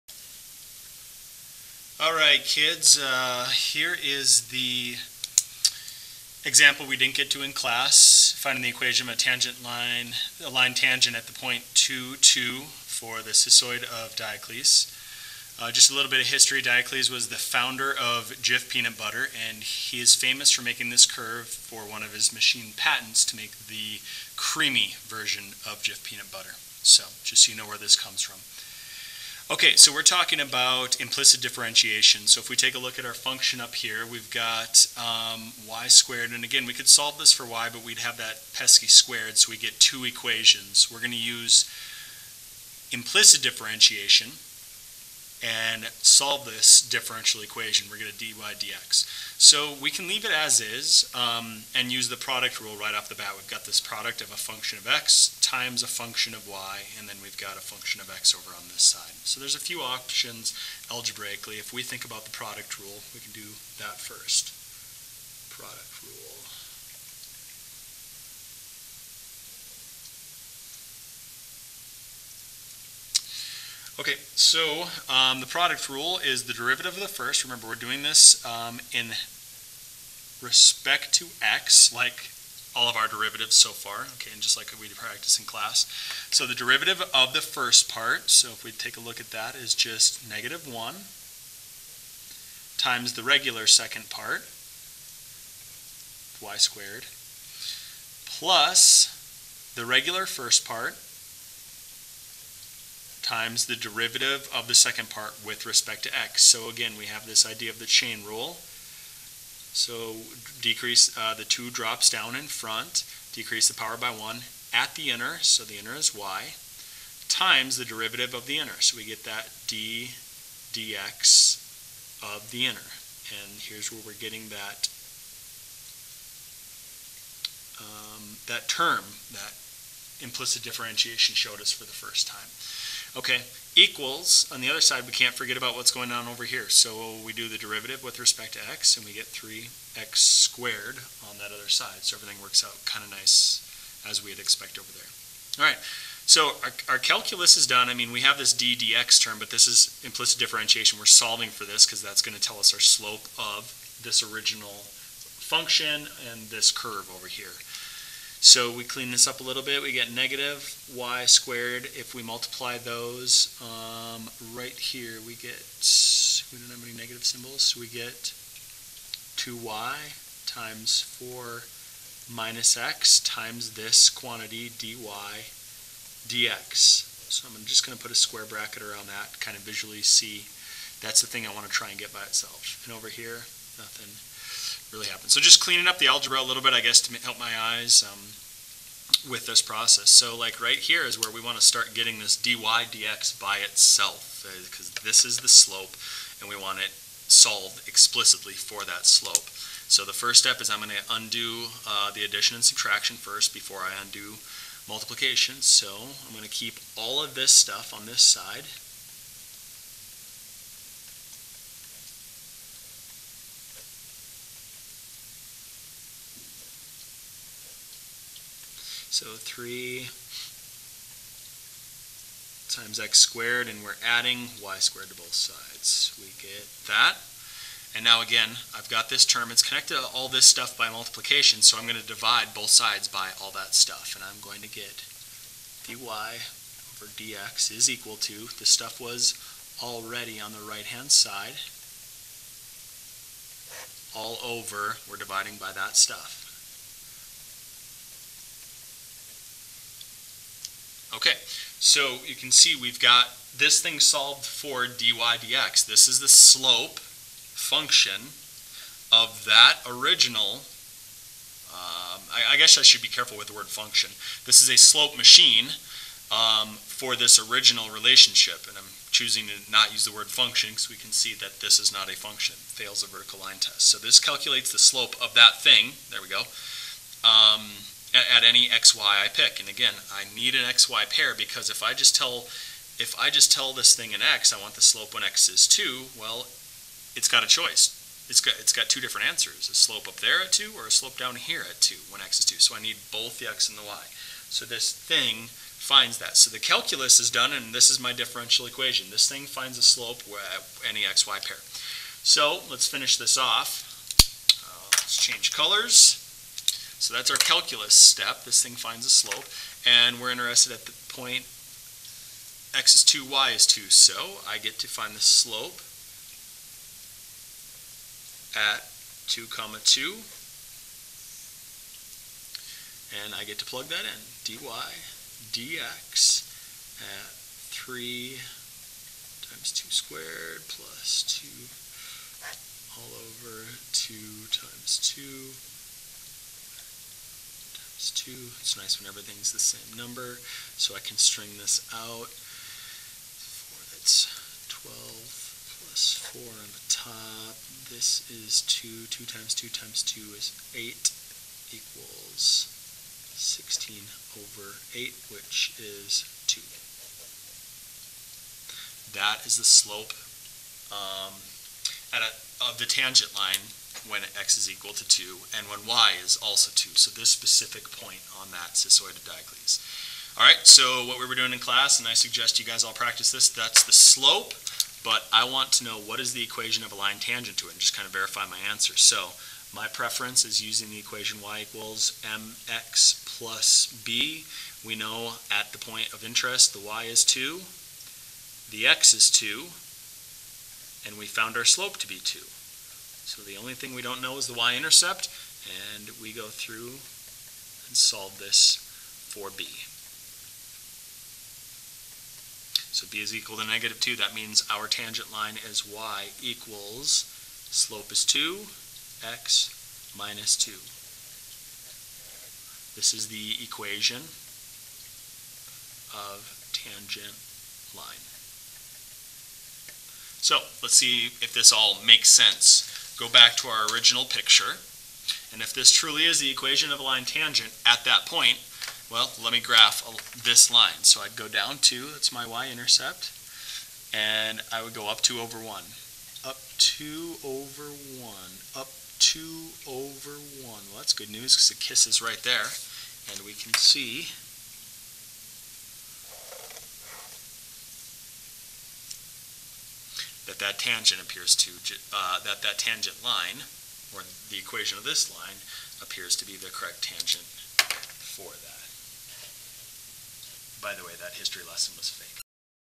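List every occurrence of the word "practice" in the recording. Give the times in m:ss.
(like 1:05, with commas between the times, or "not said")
1:24, 6:12.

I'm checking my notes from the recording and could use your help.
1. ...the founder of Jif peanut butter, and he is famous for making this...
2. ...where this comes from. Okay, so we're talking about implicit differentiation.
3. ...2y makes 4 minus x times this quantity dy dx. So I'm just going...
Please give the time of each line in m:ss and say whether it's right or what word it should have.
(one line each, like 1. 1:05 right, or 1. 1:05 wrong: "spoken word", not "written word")
1. 0:17 right
2. 0:27 right
3. 2:49 wrong: "times", not "makes".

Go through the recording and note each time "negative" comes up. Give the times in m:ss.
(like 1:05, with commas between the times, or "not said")
1:30, 2:40, 2:46, 6:43.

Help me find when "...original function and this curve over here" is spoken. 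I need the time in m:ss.
2:34.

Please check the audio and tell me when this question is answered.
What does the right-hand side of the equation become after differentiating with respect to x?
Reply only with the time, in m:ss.
2:19.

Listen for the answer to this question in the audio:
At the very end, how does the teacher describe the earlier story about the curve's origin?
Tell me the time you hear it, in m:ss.
7:42.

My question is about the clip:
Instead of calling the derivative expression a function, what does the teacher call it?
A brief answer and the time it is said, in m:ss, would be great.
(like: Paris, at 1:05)
slope machine, at 4:24.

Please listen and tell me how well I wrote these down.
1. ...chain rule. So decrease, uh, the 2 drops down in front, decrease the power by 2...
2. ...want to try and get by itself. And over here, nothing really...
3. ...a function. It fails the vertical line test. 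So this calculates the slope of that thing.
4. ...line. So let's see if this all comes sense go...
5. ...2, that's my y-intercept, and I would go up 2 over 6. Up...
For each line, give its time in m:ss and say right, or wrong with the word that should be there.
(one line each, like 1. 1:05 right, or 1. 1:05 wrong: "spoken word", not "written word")
1. 1:47 wrong: "1", not "2"
2. 3:01 right
3. 4:32 right
4. 6:57 wrong: "makes", not "comes"
5. 7:11 wrong: "1", not "6".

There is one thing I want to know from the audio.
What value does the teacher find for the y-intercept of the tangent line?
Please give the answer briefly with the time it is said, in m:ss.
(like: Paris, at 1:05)
-2, at 6:43.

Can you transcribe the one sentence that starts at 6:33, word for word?
So the only thing we don't know is the y-intercept, and we go through and solve this for b.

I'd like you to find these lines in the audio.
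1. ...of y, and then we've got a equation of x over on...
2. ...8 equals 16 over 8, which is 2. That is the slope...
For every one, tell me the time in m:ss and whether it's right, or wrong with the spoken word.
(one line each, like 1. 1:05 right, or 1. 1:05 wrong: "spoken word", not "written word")
1. 0:56 wrong: "function", not "equation"
2. 5:50 right.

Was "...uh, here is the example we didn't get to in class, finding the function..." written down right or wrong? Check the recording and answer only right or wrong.
wrong.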